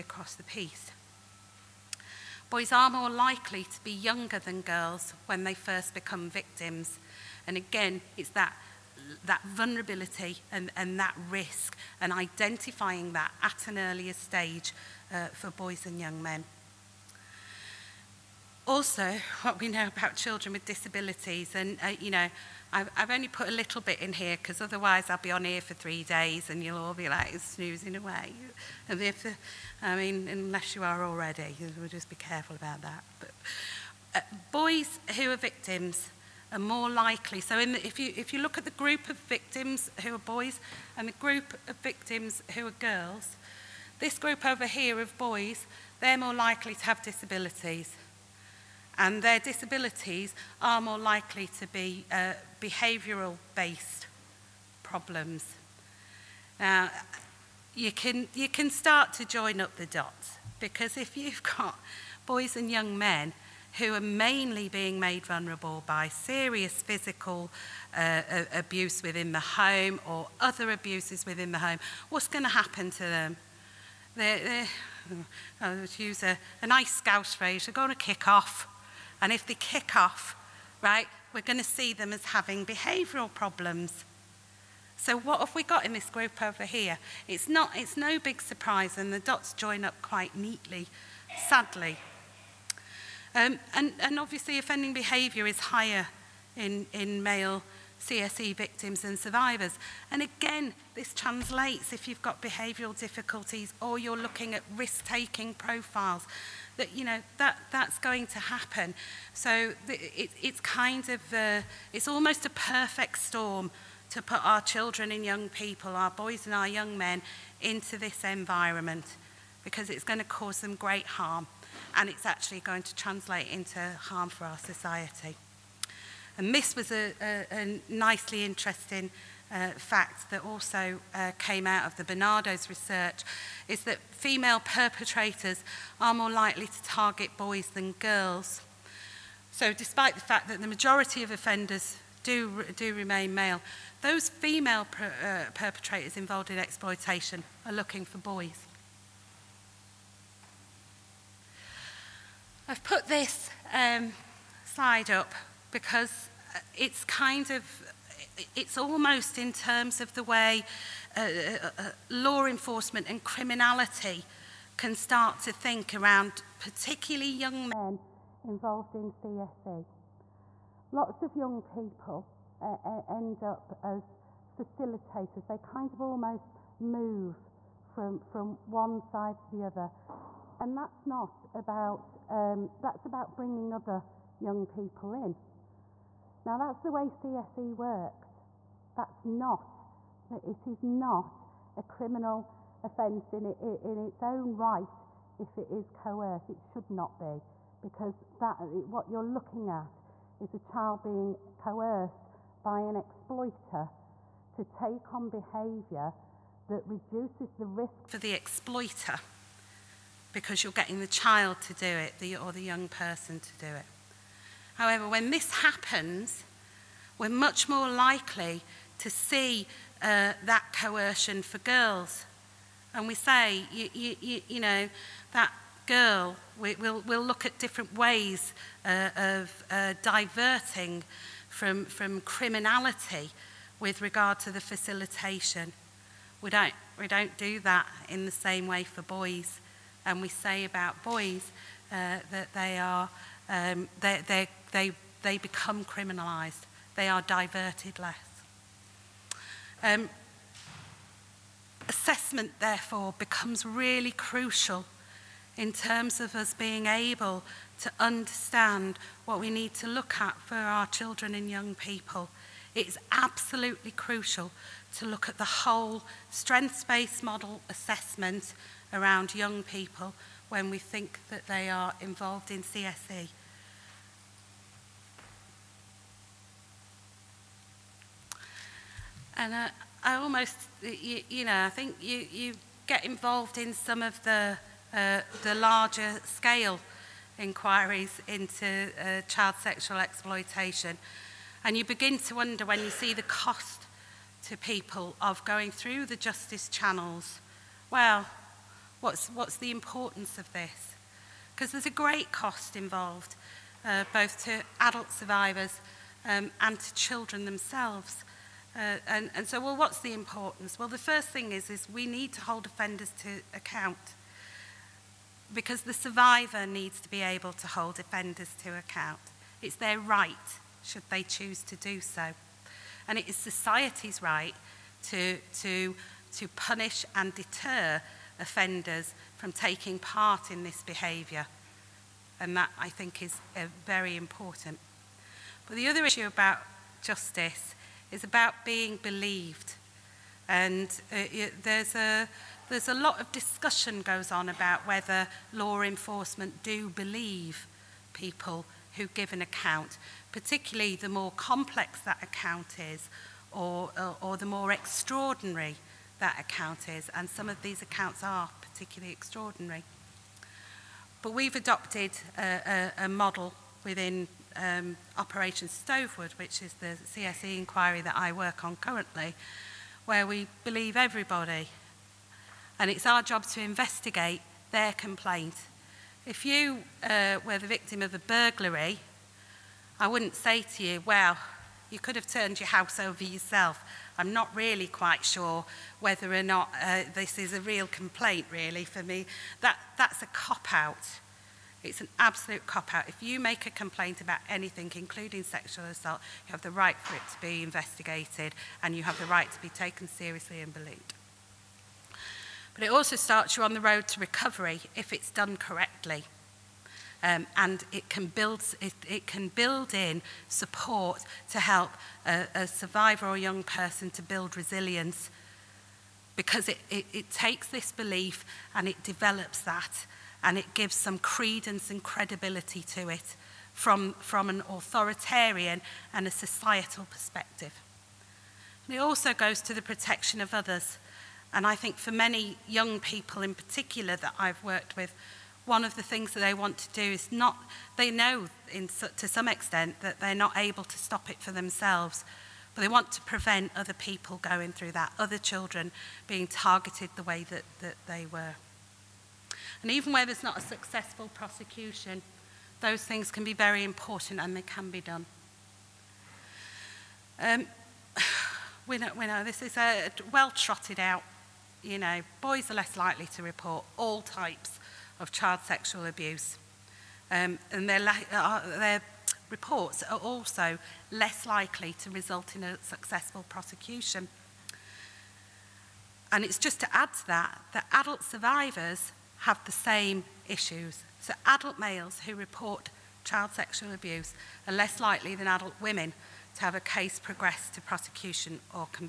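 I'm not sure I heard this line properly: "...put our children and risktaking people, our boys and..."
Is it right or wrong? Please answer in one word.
wrong.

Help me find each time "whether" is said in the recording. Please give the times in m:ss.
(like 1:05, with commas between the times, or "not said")
5:44, 6:25.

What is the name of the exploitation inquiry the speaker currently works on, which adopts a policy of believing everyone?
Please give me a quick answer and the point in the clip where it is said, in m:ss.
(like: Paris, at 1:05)
Operation Stovewood, at 6:05.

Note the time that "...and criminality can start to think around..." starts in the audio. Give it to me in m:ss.
2:43.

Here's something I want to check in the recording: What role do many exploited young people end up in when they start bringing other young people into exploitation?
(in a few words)
facilitators.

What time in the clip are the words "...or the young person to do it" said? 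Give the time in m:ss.
3:32.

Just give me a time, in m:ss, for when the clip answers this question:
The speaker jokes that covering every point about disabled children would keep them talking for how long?
0:25.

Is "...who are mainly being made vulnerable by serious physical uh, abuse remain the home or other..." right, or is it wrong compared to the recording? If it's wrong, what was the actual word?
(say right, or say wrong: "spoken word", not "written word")
wrong: "within", not "remain".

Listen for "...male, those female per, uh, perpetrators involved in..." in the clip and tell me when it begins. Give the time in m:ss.
2:23.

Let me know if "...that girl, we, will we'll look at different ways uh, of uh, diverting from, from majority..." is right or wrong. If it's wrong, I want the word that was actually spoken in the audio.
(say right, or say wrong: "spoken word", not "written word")
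wrong: "criminality", not "majority".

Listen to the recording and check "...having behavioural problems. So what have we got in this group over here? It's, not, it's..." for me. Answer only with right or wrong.
right.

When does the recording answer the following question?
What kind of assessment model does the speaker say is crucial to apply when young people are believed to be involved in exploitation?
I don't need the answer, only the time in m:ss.
4:26.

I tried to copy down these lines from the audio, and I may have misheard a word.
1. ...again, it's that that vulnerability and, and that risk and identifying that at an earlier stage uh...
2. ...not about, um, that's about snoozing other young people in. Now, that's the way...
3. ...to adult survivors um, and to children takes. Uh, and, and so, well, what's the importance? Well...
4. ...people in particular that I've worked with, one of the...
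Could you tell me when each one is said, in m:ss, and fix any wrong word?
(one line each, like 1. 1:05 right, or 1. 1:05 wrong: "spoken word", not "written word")
1. 0:07 right
2. 3:01 wrong: "bringing", not "snoozing"
3. 5:04 wrong: "themselves", not "takes"
4. 7:12 right.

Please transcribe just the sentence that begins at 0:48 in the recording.
and their disabilities are more likely to be uh, behavioural based problems.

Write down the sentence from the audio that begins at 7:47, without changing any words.
Um, and their, uh, their reports are also less likely to result in a successful prosecution.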